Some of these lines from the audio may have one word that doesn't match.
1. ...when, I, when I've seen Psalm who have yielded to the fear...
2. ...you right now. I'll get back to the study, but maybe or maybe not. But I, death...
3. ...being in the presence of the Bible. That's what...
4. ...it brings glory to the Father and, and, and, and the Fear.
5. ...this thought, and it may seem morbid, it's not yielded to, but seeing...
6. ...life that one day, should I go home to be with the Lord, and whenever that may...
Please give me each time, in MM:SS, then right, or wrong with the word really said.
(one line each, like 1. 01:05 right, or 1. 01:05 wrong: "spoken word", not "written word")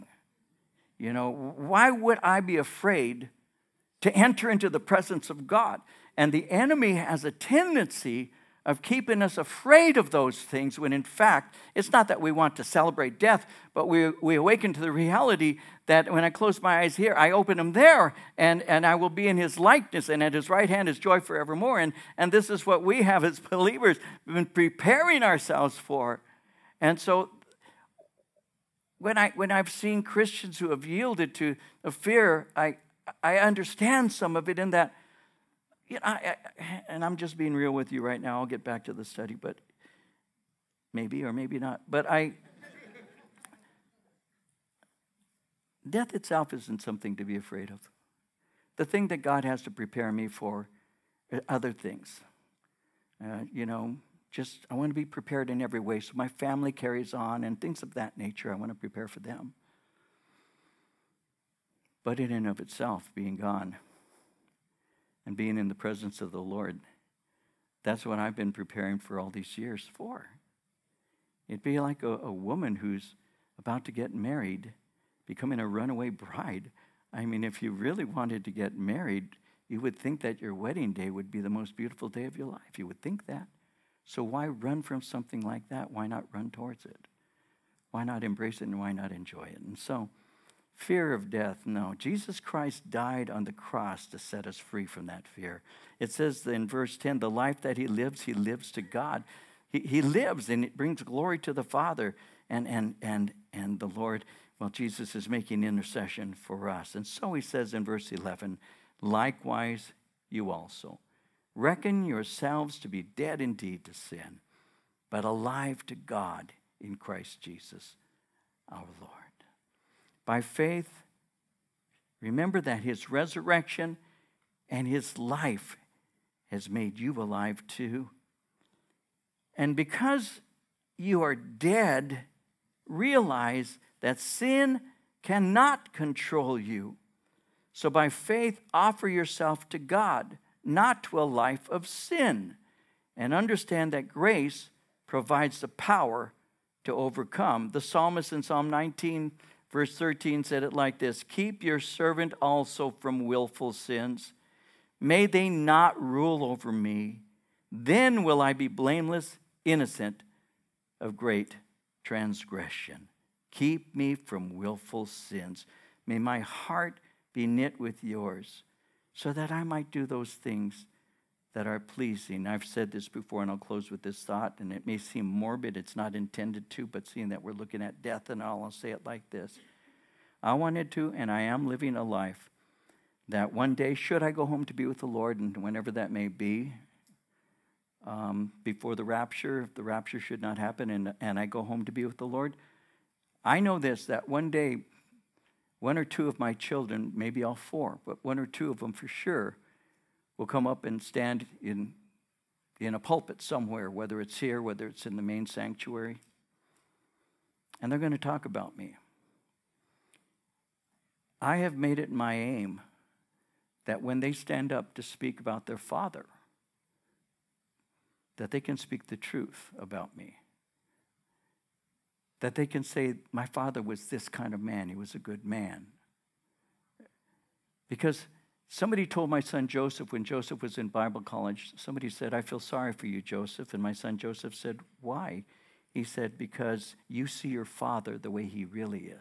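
1. 00:28 wrong: "Christians", not "Psalm"
2. 00:37 right
3. 01:05 wrong: "Lord", not "Bible"
4. 01:40 wrong: "Lord", not "Fear"
5. 02:54 wrong: "intended", not "yielded"
6. 03:02 right.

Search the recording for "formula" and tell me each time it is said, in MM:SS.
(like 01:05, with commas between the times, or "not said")
not said.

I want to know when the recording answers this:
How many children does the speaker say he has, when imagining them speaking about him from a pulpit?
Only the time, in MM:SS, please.
03:17.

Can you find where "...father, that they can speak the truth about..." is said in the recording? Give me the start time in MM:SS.
03:35.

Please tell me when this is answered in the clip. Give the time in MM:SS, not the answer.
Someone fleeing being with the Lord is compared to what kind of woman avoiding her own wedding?
01:15.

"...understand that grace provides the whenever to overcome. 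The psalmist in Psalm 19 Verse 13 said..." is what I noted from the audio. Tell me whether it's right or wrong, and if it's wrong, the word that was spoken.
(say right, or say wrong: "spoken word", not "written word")
wrong: "power", not "whenever".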